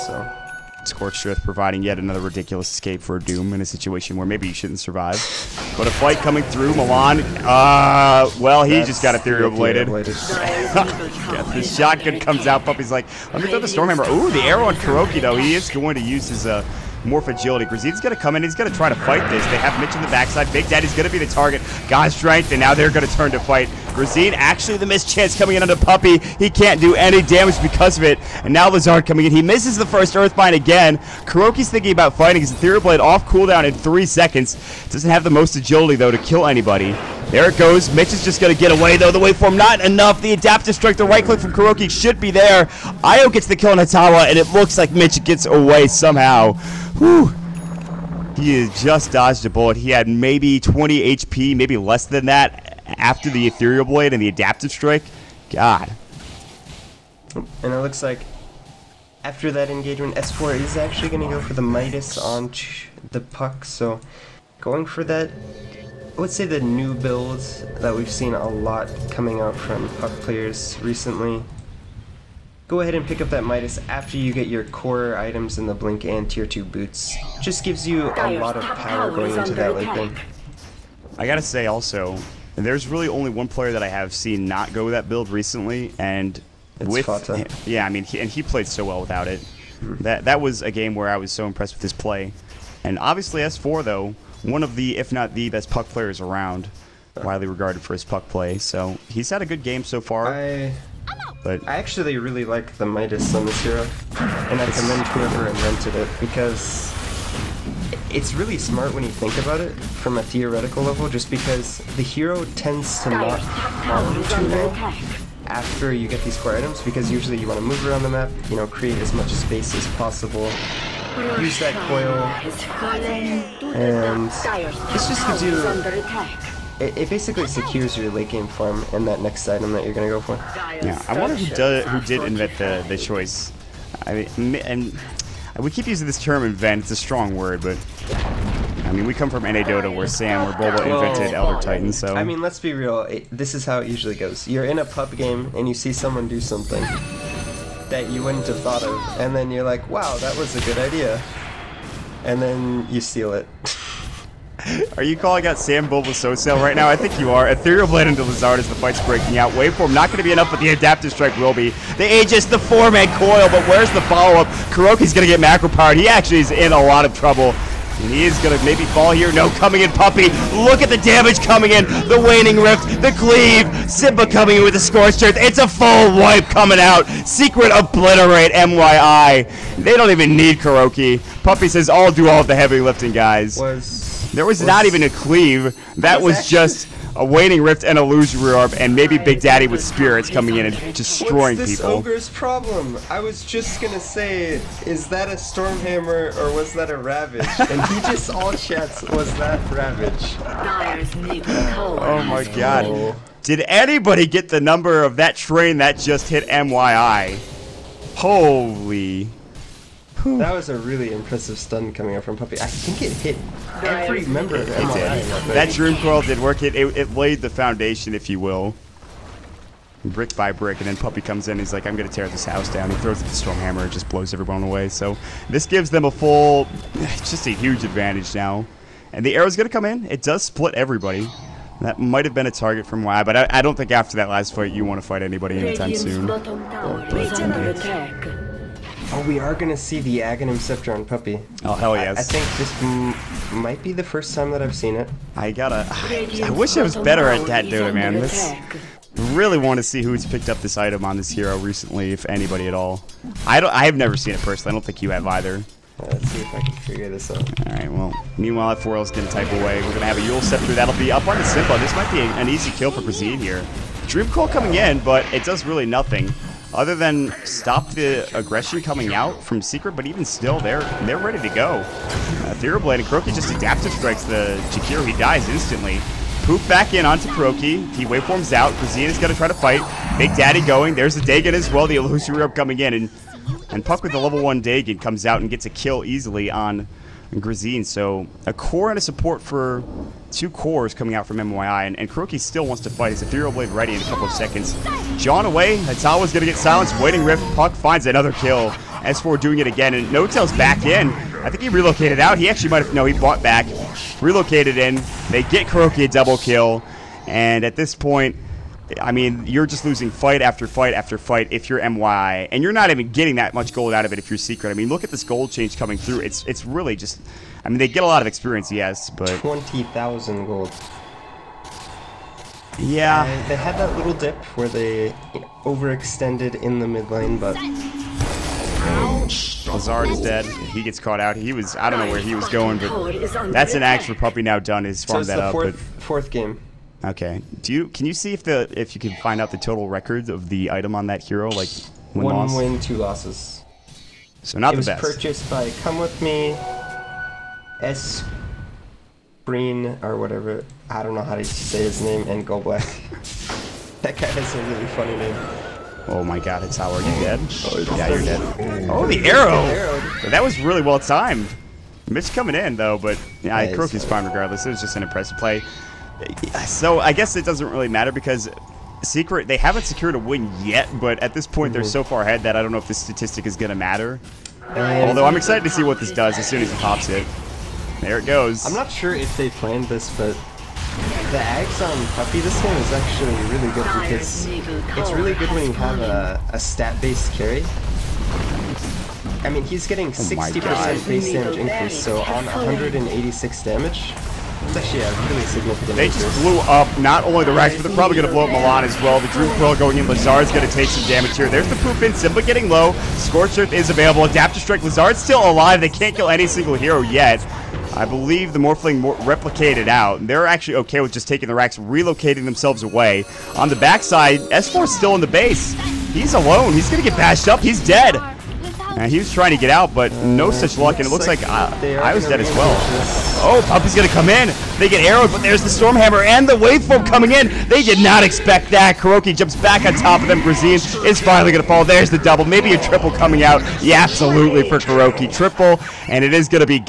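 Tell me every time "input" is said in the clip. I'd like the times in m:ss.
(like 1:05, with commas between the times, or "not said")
not said.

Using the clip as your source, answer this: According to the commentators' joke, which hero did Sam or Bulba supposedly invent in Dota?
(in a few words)
Elder Titan.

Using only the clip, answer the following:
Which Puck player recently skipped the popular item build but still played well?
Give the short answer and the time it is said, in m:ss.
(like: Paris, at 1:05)
Fata, at 1:27.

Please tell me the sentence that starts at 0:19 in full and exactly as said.
They have Mitch in the backside.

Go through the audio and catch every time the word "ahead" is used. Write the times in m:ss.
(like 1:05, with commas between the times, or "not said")
1:12, 6:12.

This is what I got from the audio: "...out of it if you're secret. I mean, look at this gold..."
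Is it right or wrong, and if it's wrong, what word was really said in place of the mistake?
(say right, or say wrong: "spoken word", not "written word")
right.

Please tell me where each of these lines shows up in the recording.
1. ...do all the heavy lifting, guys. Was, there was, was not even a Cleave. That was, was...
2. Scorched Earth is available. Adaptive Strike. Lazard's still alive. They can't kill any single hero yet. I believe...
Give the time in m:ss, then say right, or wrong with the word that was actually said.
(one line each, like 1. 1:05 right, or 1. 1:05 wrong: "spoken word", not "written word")
1. 3:02 right
2. 6:43 right.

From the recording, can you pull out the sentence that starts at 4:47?
So a core and a support for two cores coming out from MYI.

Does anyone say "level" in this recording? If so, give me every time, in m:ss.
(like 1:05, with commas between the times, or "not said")
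1:50, 4:44.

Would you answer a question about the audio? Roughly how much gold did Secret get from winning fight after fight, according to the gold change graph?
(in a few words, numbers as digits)
20000.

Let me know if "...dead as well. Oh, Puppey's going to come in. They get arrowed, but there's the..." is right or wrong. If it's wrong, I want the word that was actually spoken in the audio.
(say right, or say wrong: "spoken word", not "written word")
right.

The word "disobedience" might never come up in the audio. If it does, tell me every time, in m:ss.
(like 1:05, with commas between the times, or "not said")
not said.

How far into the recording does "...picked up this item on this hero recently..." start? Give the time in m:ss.
4:10.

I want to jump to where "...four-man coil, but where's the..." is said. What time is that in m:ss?
2:42.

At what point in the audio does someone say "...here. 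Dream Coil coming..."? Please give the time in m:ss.
4:23.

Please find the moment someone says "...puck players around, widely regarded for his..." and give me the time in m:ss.
1:35.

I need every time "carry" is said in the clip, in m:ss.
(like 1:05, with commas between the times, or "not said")
6:27.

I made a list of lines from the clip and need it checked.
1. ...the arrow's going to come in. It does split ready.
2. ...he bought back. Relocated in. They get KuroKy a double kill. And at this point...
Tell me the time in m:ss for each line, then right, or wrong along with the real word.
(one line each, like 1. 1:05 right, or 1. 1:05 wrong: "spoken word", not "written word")
1. 3:49 wrong: "everybody", not "ready"
2. 5:03 right.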